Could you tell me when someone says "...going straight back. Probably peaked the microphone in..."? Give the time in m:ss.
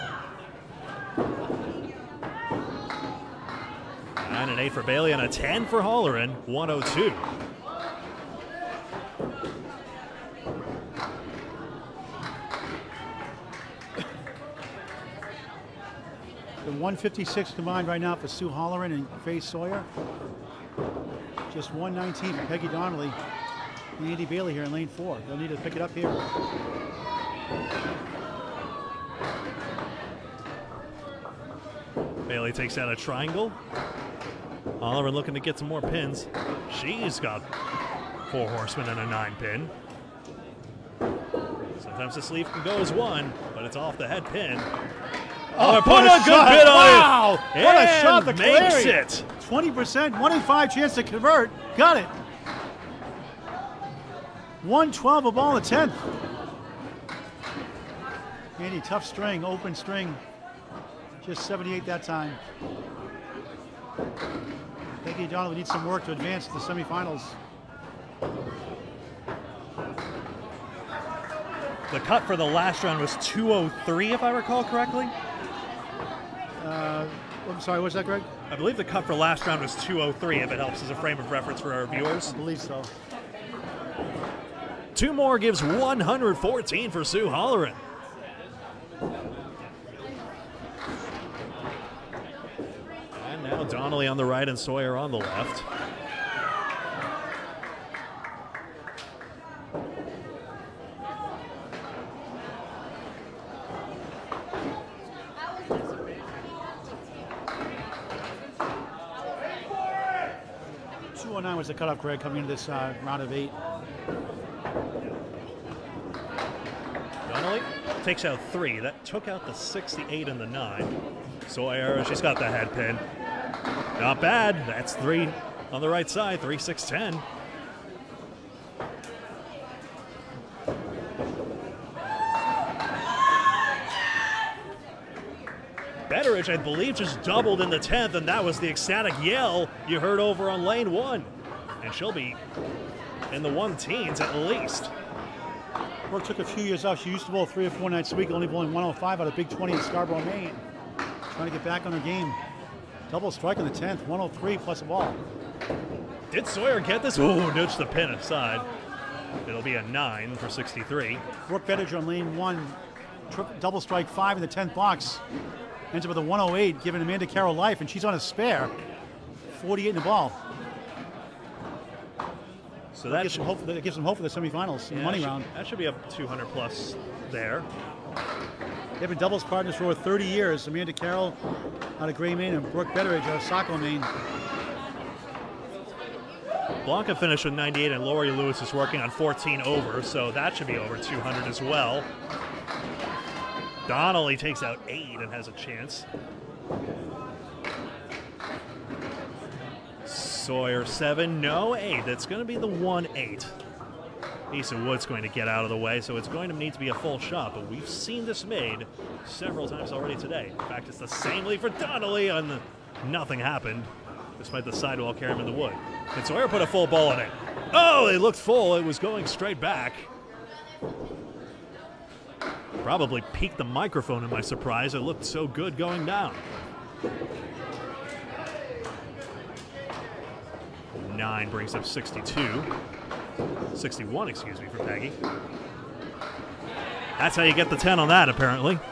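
3:38.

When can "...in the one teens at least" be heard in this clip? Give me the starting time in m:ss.
2:23.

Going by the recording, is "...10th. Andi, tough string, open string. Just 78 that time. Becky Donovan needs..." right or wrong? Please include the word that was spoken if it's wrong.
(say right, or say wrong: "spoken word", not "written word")
right.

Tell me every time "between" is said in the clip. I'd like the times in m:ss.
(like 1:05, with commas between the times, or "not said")
not said.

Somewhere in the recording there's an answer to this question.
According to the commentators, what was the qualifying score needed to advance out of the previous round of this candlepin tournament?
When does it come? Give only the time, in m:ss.
1:13.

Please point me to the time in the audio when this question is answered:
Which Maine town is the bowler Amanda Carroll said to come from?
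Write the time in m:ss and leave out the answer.
3:02.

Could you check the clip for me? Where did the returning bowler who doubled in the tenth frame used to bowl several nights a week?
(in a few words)
Big 20 in Scarborough, Maine.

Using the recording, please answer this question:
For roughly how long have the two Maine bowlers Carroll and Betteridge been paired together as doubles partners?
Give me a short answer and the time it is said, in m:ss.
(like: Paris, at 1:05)
Over 30 years, at 2:59.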